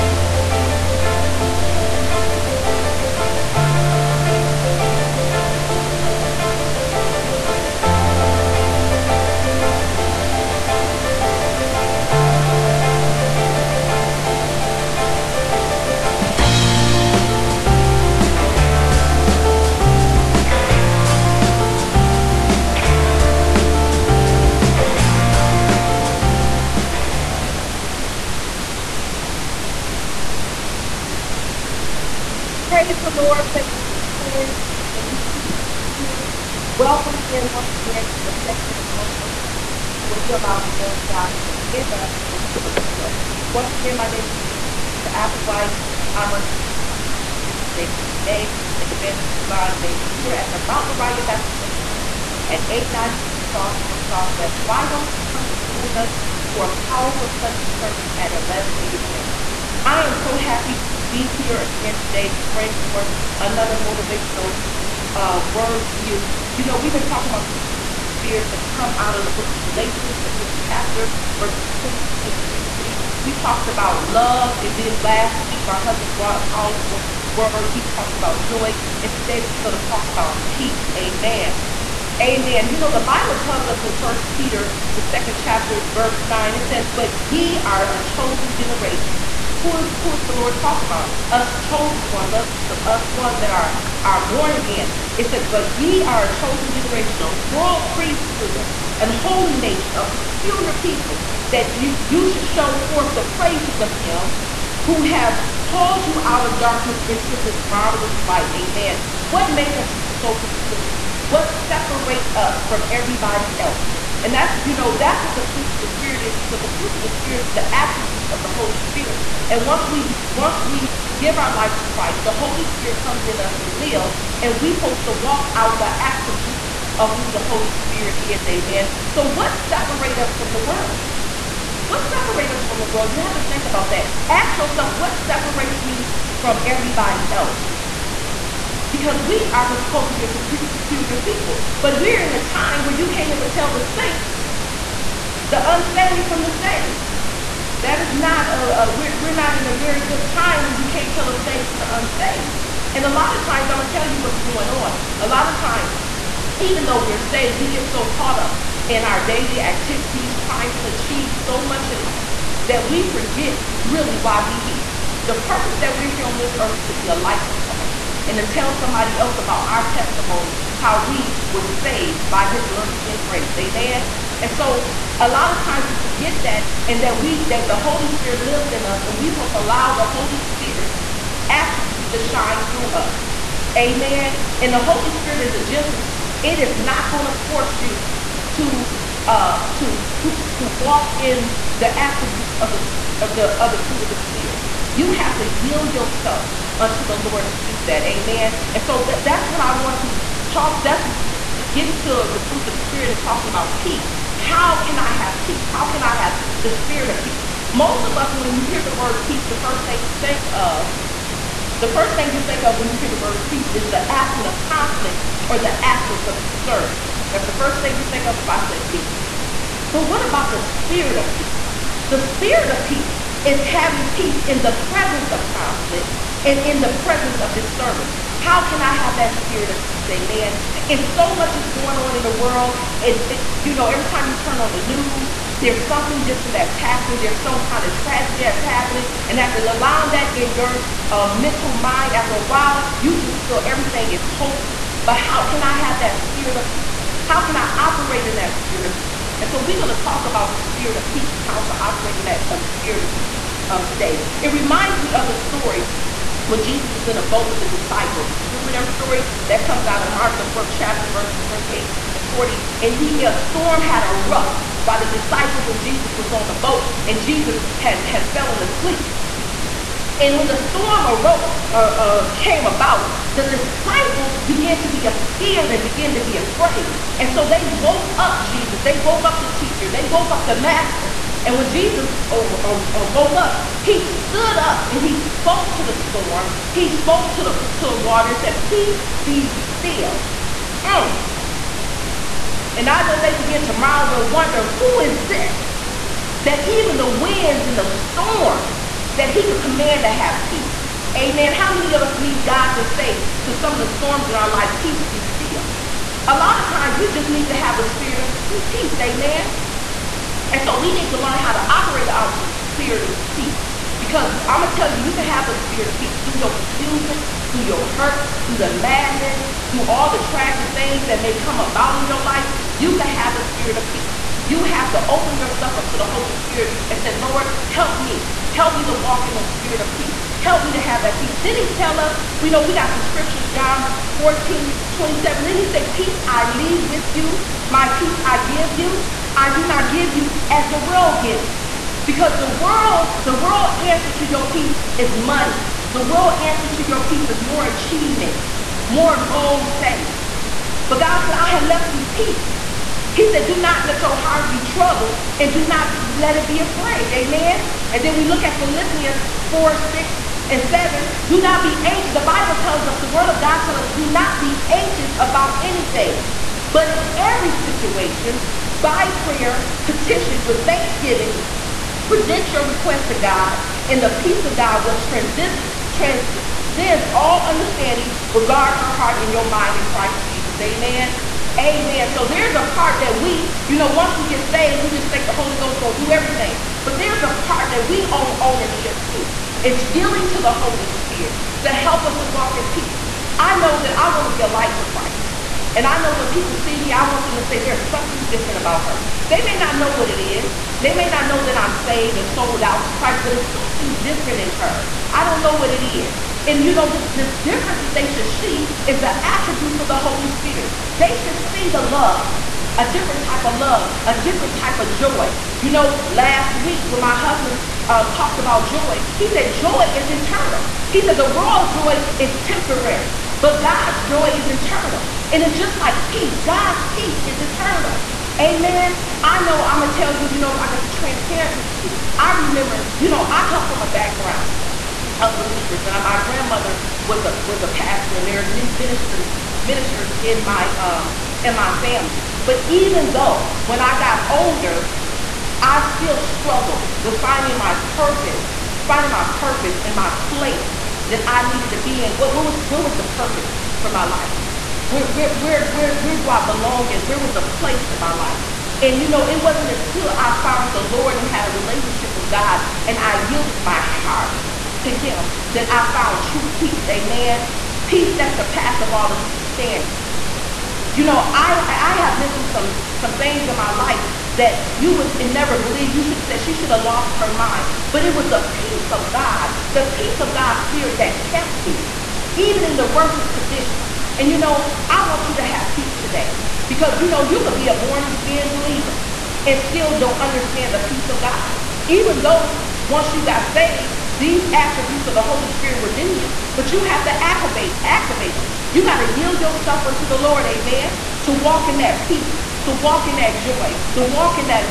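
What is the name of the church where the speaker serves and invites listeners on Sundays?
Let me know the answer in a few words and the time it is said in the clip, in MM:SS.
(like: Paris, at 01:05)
Mount Moriah Baptist Worship Center, at 00:50.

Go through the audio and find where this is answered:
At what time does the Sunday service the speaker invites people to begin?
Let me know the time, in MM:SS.
00:58.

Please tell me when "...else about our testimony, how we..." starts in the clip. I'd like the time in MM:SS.
02:49.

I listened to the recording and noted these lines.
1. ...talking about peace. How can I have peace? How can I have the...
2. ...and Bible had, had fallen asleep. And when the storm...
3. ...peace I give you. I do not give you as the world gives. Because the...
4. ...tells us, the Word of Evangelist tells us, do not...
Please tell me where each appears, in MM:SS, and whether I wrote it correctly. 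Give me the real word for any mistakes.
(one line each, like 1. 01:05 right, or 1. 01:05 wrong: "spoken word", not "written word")
1. 03:23 right
2. 04:27 wrong: "Jesus", not "Bible"
3. 05:37 right
4. 06:02 wrong: "God", not "Evangelist".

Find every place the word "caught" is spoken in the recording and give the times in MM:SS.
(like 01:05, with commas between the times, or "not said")
02:38.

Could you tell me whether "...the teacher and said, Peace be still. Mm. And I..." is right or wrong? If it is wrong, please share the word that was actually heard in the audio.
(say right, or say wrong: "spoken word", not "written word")
wrong: "water", not "teacher".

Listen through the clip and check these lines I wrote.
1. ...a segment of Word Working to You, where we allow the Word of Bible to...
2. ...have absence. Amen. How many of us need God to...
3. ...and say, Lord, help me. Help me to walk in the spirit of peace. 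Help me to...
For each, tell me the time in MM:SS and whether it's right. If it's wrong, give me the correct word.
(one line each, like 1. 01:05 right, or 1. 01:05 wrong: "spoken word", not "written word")
1. 00:38 wrong: "God", not "Bible"
2. 05:00 wrong: "peace", not "absence"
3. 05:26 right.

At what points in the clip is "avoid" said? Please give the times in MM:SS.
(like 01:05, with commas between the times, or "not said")
not said.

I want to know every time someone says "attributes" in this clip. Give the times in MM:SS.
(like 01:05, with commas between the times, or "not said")
01:57, 02:06, 03:01, 03:11, 06:49, 08:14.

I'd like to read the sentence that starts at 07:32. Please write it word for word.
What, what was what was the purpose for my life?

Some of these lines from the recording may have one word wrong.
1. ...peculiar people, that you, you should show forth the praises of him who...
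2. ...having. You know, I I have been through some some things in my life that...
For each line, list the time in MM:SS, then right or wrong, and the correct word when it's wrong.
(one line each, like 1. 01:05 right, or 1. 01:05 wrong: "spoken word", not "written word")
1. 01:40 right
2. 07:49 wrong: "understanding", not "having".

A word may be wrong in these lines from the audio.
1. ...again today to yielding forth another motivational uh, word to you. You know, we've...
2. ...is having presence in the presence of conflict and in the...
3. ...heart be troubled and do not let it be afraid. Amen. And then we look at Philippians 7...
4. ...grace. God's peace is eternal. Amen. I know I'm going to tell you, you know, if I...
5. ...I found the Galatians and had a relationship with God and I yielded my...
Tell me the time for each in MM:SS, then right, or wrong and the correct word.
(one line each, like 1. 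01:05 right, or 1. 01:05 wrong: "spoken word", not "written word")
1. 01:01 wrong: "bring", not "yielding"
2. 03:43 wrong: "peace", not "presence"
3. 05:54 wrong: "4", not "7"
4. 07:06 wrong: "peace", not "grace"
5. 07:40 wrong: "Lord", not "Galatians".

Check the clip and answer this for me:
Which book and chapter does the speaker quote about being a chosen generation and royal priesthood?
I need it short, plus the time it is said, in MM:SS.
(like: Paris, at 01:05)
First Peter 2, at 01:23.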